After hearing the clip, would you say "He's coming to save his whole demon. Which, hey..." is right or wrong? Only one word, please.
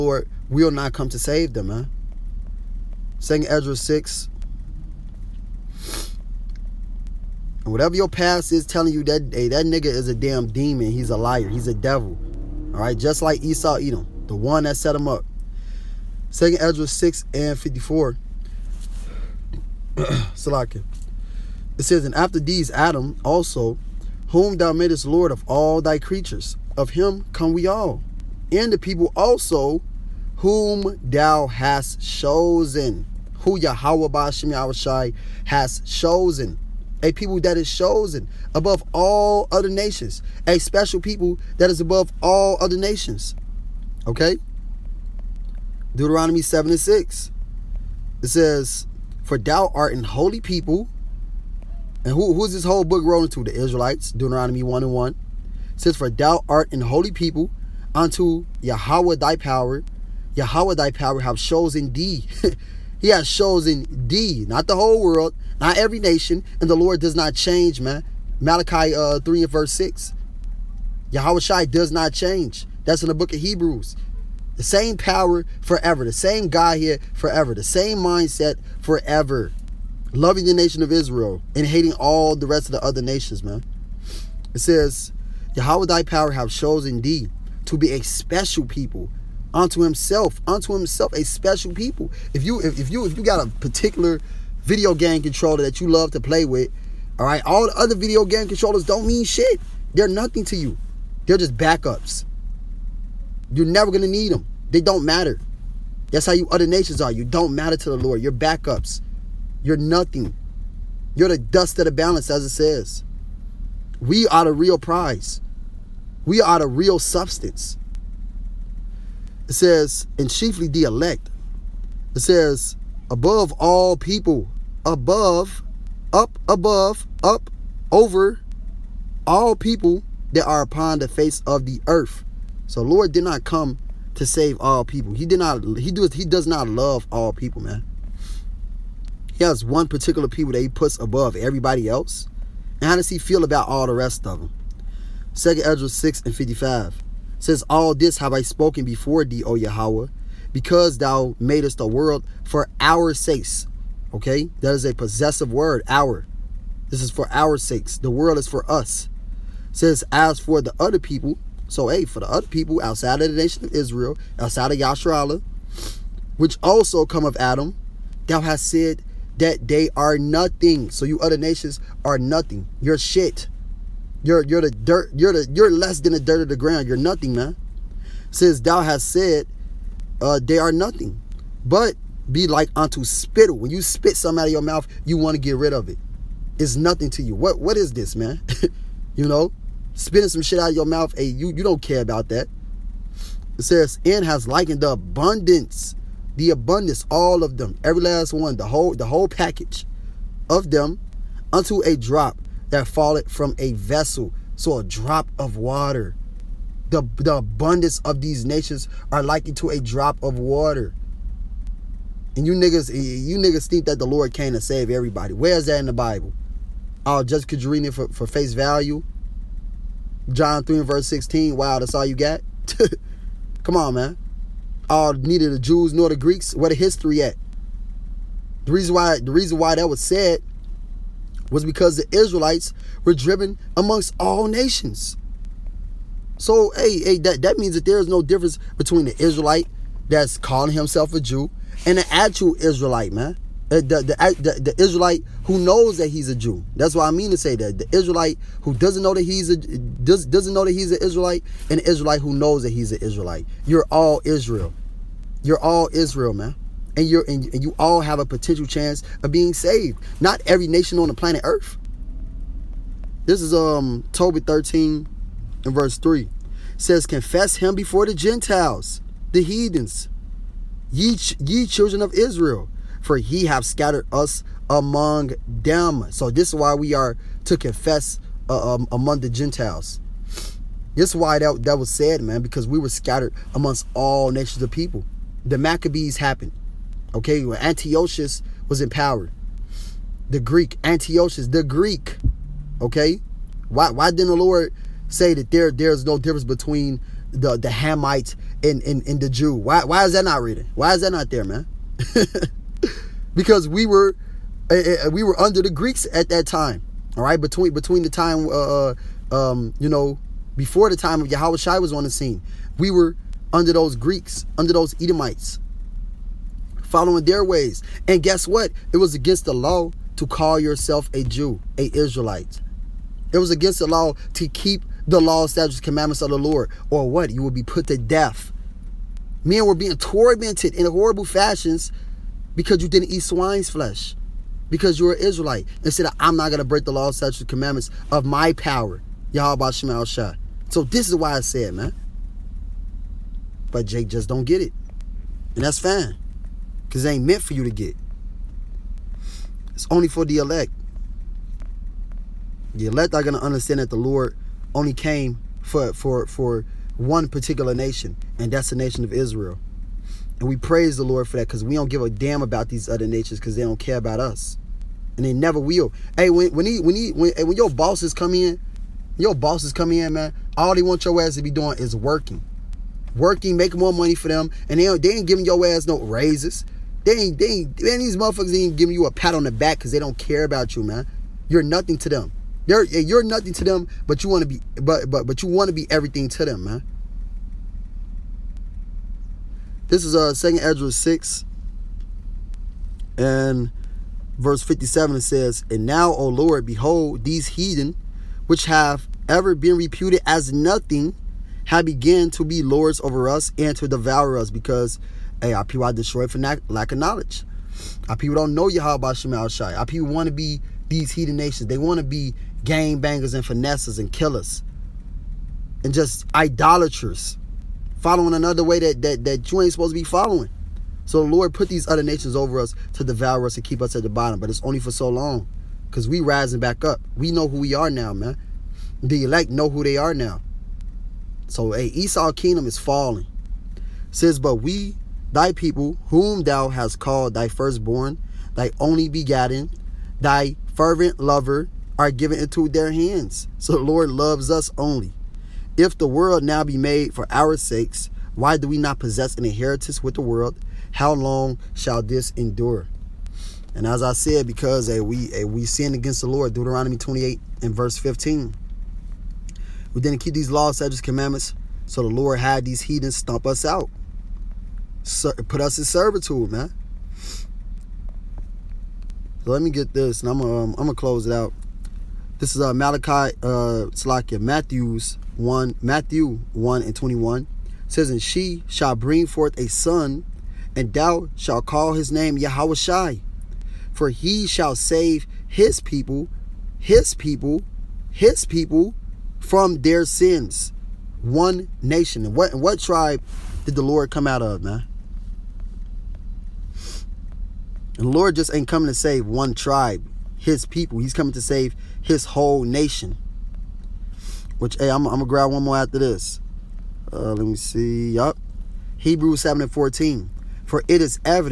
wrong.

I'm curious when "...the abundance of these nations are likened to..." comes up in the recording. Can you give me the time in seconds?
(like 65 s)
207 s.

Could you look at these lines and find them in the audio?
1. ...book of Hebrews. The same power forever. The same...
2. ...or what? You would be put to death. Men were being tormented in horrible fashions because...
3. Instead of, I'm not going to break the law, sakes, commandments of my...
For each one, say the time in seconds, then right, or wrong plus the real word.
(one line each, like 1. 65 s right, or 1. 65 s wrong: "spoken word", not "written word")
1. 73 s right
2. 326 s right
3. 335 s wrong: "statutes", not "sakes".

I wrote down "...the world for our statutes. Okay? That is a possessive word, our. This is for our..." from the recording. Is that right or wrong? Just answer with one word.
wrong.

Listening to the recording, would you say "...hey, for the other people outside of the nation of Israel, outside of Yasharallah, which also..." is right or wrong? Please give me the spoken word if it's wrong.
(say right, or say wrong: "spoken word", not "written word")
right.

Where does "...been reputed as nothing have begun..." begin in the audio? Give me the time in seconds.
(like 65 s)
399 s.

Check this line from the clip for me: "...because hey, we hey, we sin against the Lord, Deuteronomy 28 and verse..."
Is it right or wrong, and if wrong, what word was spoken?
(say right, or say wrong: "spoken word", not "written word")
right.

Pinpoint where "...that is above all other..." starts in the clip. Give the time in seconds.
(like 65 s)
41 s.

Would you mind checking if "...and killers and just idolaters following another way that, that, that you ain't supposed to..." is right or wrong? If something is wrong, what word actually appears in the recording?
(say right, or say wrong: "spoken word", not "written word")
right.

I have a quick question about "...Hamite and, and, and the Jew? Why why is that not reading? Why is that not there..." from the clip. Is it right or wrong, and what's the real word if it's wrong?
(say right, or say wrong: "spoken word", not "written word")
right.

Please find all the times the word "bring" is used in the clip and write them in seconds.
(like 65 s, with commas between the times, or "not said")
478 s.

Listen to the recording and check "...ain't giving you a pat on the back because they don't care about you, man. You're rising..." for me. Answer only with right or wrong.
wrong.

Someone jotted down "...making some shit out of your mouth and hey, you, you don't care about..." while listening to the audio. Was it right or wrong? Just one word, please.
wrong.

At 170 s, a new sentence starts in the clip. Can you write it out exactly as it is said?
So you other nations are nothing.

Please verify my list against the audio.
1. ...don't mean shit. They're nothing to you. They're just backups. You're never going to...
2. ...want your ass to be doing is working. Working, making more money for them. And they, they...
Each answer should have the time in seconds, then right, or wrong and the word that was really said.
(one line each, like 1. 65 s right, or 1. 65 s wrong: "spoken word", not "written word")
1. 98 s right
2. 370 s right.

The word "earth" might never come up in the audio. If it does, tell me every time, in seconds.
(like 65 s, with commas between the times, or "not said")
131 s, 261 s.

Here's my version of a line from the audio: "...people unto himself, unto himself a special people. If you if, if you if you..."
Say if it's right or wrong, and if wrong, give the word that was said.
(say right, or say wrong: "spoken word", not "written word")
right.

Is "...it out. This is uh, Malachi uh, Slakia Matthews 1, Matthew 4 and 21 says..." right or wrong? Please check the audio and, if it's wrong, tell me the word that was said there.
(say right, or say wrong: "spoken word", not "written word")
wrong: "1", not "4".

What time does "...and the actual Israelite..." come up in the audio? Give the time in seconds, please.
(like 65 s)
241 s.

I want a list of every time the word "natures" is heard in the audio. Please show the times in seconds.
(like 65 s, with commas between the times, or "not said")
363 s.